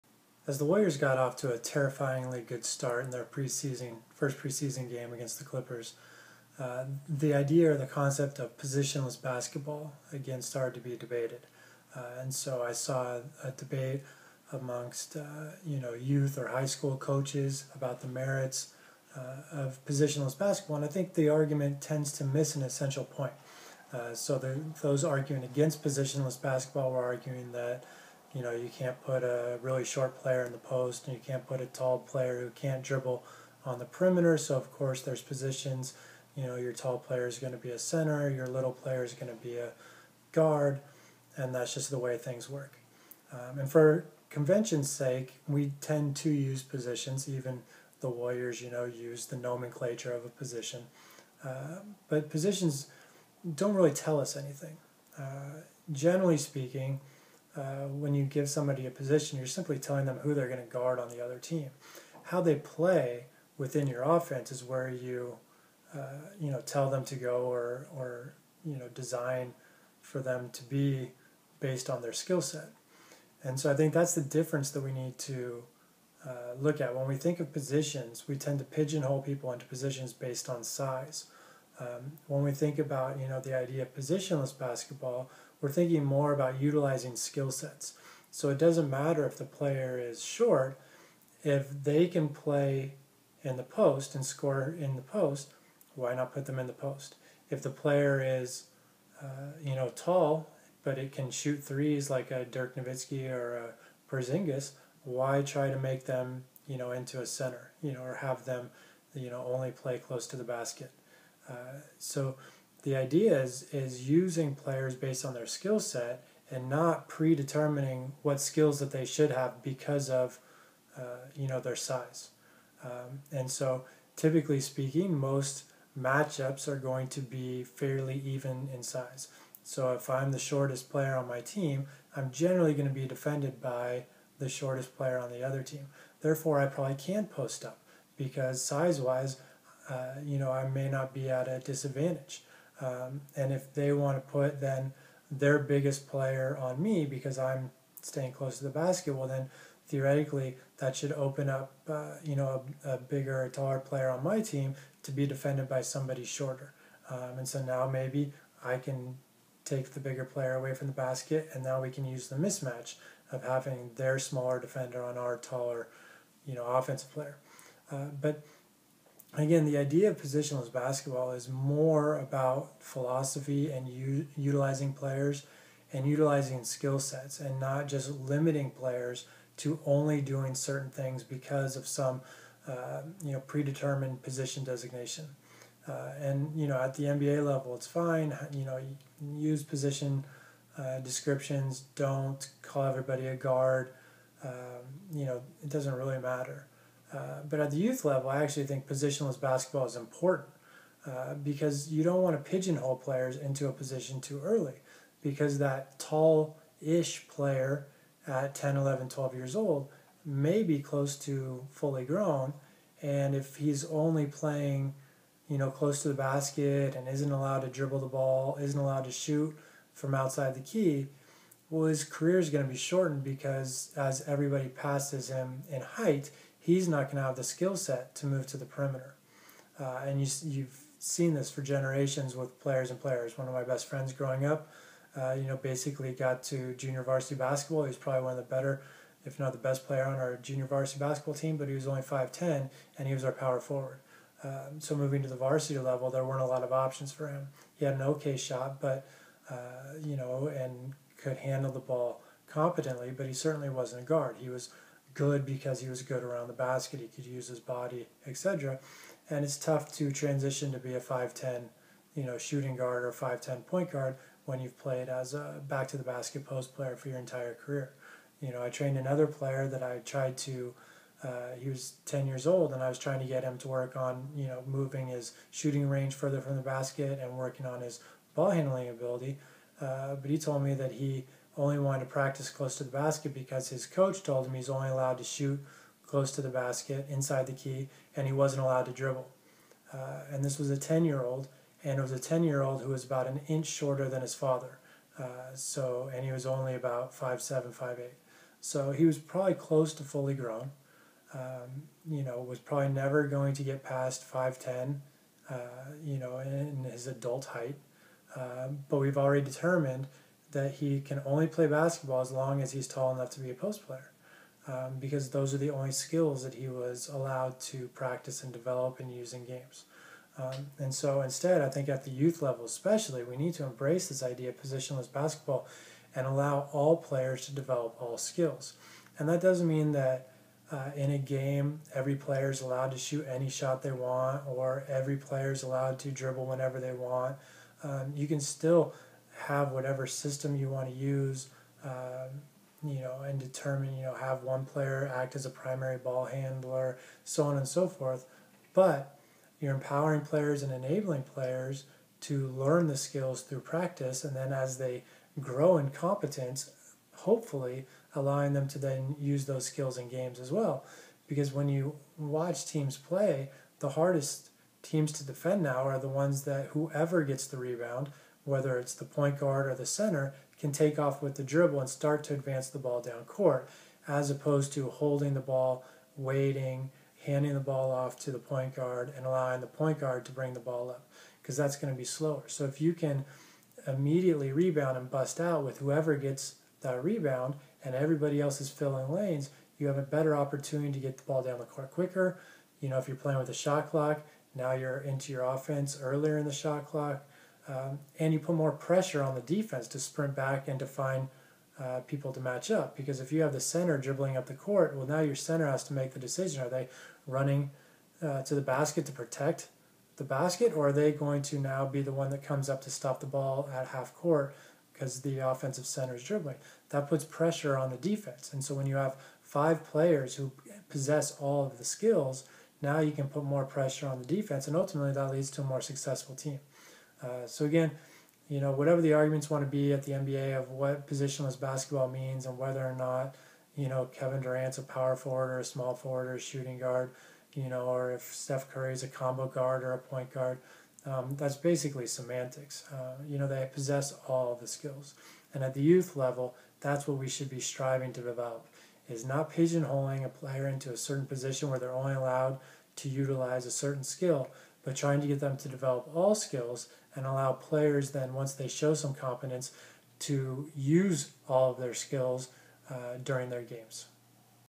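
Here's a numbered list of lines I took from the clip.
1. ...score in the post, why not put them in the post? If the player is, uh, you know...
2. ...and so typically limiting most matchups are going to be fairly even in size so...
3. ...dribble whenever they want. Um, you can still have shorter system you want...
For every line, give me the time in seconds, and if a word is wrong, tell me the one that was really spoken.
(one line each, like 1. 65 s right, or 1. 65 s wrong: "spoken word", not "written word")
1. 94 s right
2. 123 s wrong: "speaking", not "limiting"
3. 336 s wrong: "whatever", not "shorter".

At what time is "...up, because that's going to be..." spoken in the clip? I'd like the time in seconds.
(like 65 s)
380 s.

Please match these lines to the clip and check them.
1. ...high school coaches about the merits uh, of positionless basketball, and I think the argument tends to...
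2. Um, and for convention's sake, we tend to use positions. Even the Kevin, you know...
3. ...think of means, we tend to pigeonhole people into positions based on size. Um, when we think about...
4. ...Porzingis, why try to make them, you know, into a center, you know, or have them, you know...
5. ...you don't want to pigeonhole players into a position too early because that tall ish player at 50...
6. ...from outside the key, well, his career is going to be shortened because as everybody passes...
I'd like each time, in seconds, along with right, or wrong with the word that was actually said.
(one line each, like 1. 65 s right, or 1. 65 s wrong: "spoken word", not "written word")
1. 16 s right
2. 43 s wrong: "Warriors", not "Kevin"
3. 77 s wrong: "positions", not "means"
4. 104 s right
5. 201 s wrong: "10", not "50"
6. 219 s right.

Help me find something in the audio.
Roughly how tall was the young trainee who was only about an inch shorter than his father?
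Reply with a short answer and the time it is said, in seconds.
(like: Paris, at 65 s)
5'7 to 5'8, at 297 s.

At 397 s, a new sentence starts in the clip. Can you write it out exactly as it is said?
Um, and you put more pressure on the defense to sprint back and to find uh, people to match up.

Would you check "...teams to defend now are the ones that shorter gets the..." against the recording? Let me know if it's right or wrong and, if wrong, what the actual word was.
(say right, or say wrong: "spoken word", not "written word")
wrong: "whoever", not "shorter".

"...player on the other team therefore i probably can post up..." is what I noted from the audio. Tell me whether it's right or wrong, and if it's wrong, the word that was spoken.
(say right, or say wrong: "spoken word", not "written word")
right.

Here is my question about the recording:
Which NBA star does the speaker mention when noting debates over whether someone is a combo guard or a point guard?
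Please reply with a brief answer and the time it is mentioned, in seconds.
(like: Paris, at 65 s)
Steph Curry, at 438 s.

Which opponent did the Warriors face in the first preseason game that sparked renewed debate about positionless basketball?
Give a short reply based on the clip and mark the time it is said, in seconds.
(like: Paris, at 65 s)
Clippers, at 5 s.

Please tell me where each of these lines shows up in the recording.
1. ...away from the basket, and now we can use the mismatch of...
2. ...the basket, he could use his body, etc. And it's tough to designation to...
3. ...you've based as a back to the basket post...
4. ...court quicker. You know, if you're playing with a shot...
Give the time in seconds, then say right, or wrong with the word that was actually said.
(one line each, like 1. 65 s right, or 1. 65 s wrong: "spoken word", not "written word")
1. 160 s right
2. 256 s wrong: "transition", not "designation"
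3. 264 s wrong: "played", not "based"
4. 391 s right.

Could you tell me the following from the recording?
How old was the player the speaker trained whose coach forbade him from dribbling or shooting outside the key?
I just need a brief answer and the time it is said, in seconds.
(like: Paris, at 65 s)
10, at 272 s.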